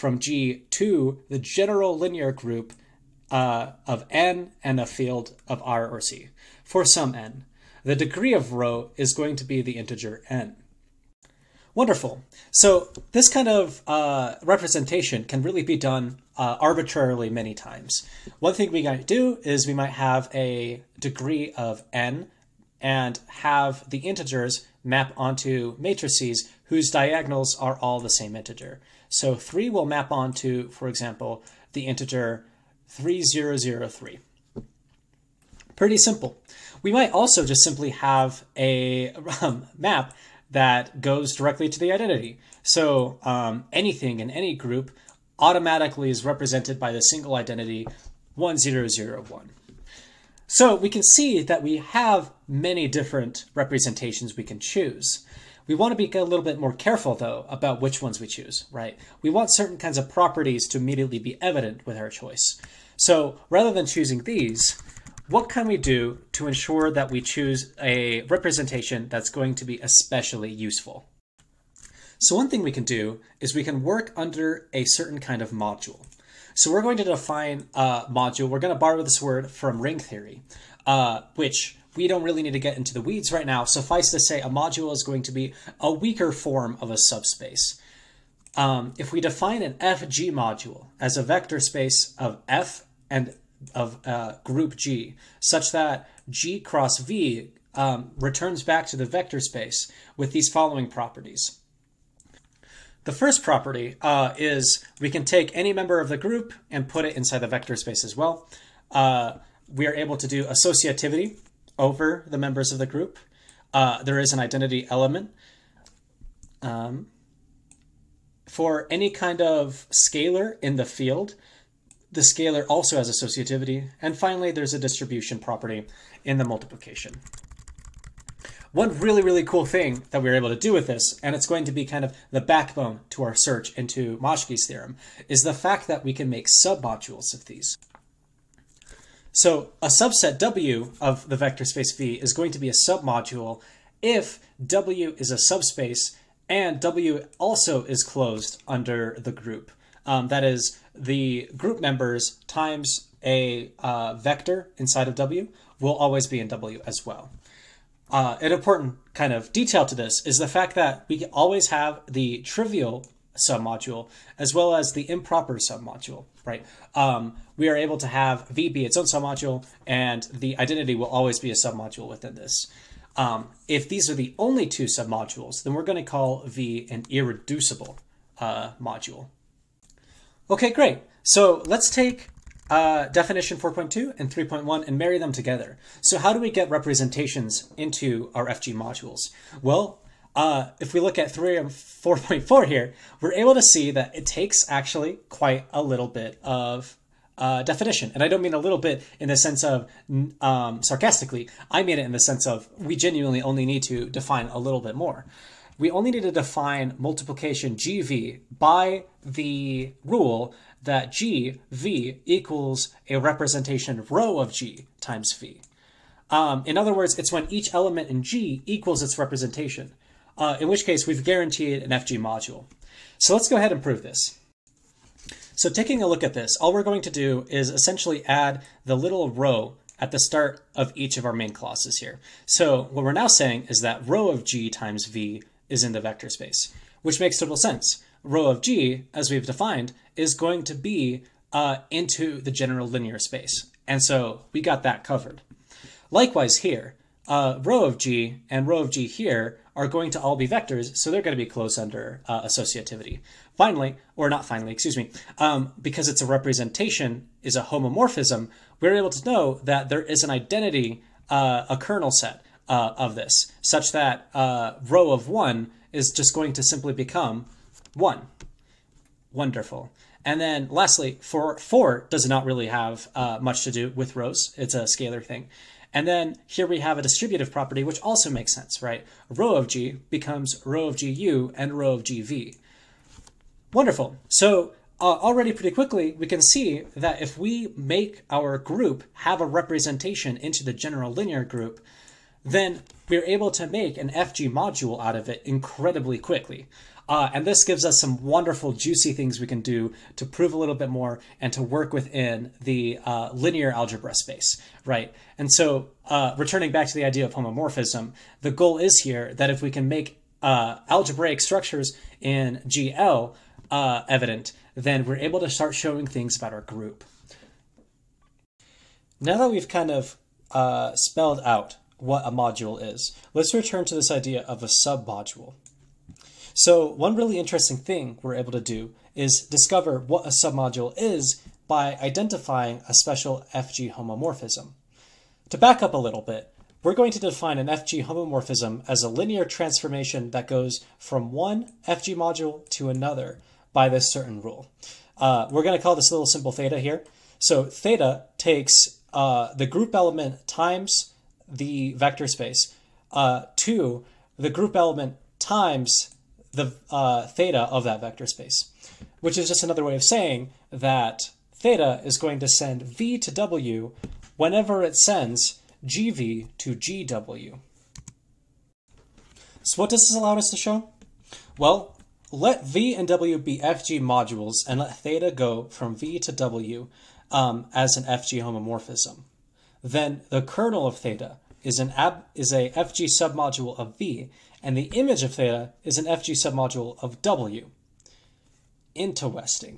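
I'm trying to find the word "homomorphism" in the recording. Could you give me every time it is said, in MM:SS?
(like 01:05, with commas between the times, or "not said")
04:17, 05:07, 05:33, 05:38, 06:18.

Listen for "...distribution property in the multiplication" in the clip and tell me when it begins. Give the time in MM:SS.
02:04.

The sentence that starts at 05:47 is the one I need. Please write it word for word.
So theta takes uh, the group element times the vector space.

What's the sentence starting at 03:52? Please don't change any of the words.
So what we're now saying is that rho of g times v is in the vector space, which makes total sense.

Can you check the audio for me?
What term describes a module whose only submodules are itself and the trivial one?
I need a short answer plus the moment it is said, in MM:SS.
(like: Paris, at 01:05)
irreducible, at 02:57.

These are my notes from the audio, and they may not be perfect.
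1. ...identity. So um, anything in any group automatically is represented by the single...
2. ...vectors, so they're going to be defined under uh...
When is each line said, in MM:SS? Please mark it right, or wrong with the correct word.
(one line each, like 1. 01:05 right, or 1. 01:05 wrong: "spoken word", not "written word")
1. 00:41 right
2. 04:10 wrong: "closed", not "defined".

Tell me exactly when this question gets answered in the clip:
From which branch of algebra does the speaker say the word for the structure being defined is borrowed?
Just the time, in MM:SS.
01:19.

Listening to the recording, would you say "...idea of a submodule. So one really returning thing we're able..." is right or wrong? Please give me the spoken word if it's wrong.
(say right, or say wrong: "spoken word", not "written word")
wrong: "interesting", not "returning".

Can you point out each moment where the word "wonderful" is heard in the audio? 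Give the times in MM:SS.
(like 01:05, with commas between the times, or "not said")
00:11, 04:29, 04:43, 04:58.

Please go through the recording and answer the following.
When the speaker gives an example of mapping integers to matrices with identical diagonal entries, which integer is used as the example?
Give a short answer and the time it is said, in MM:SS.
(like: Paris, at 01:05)
3, at 00:29.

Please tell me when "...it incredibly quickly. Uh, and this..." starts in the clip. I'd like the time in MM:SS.
04:55.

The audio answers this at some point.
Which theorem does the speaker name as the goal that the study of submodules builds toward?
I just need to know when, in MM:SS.
02:14.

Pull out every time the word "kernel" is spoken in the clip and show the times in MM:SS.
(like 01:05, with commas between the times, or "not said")
04:21, 06:20.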